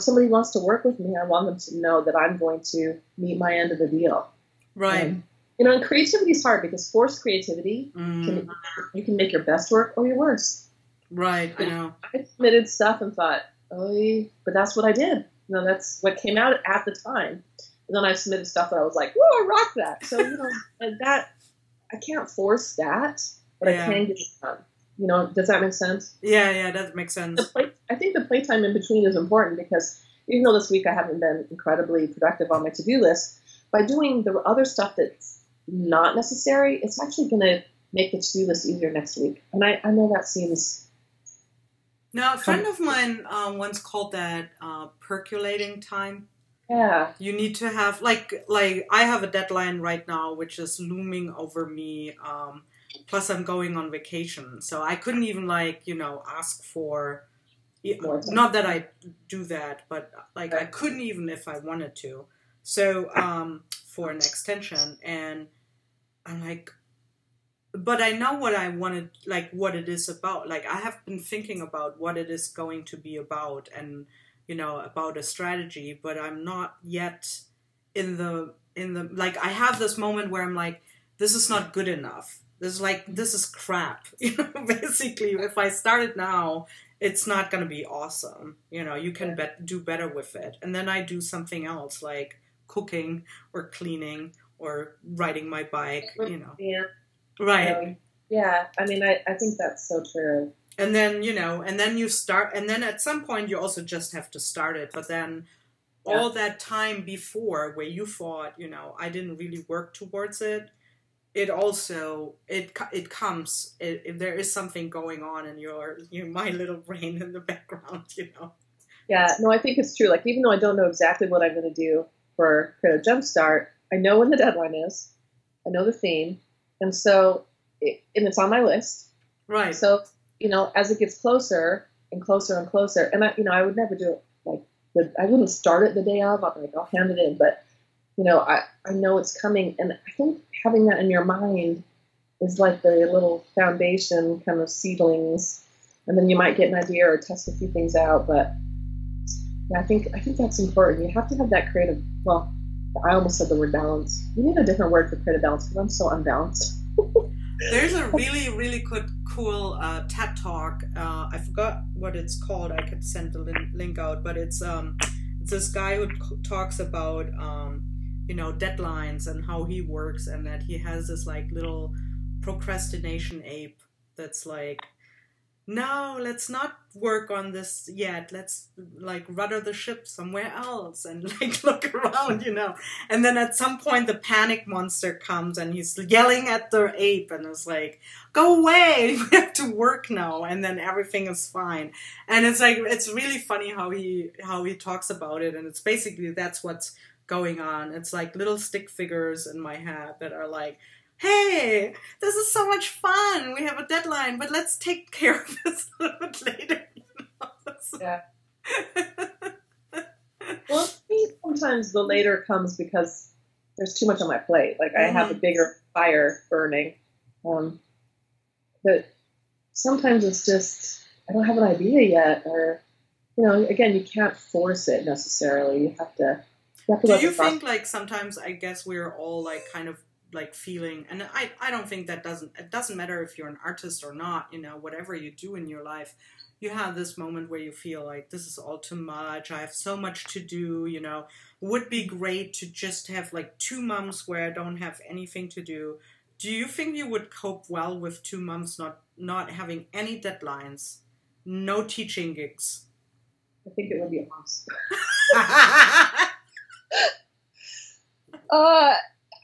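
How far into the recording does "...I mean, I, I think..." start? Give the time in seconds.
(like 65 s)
98 s.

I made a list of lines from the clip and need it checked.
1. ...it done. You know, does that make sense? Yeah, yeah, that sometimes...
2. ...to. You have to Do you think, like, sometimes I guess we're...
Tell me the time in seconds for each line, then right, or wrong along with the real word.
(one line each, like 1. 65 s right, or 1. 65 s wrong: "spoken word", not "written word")
1. 24 s wrong: "makes", not "sometimes"
2. 226 s right.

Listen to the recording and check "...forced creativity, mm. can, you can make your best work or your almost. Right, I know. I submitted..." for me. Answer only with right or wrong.
wrong.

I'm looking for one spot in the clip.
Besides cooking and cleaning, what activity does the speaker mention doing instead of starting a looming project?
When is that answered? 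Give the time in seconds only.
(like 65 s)
95 s.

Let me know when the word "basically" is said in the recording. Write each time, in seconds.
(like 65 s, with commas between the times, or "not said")
84 s, 195 s.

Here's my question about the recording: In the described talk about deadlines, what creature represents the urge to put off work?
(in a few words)
procrastination ape.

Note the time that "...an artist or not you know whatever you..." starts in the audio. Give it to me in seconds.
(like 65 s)
233 s.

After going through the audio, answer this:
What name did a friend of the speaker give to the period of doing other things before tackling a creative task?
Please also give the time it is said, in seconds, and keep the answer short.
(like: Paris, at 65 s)
percolating time, at 44 s.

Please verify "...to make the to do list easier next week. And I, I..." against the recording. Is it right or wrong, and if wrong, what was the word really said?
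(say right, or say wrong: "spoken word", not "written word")
right.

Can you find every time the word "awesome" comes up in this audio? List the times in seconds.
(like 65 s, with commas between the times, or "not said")
87 s, 254 s.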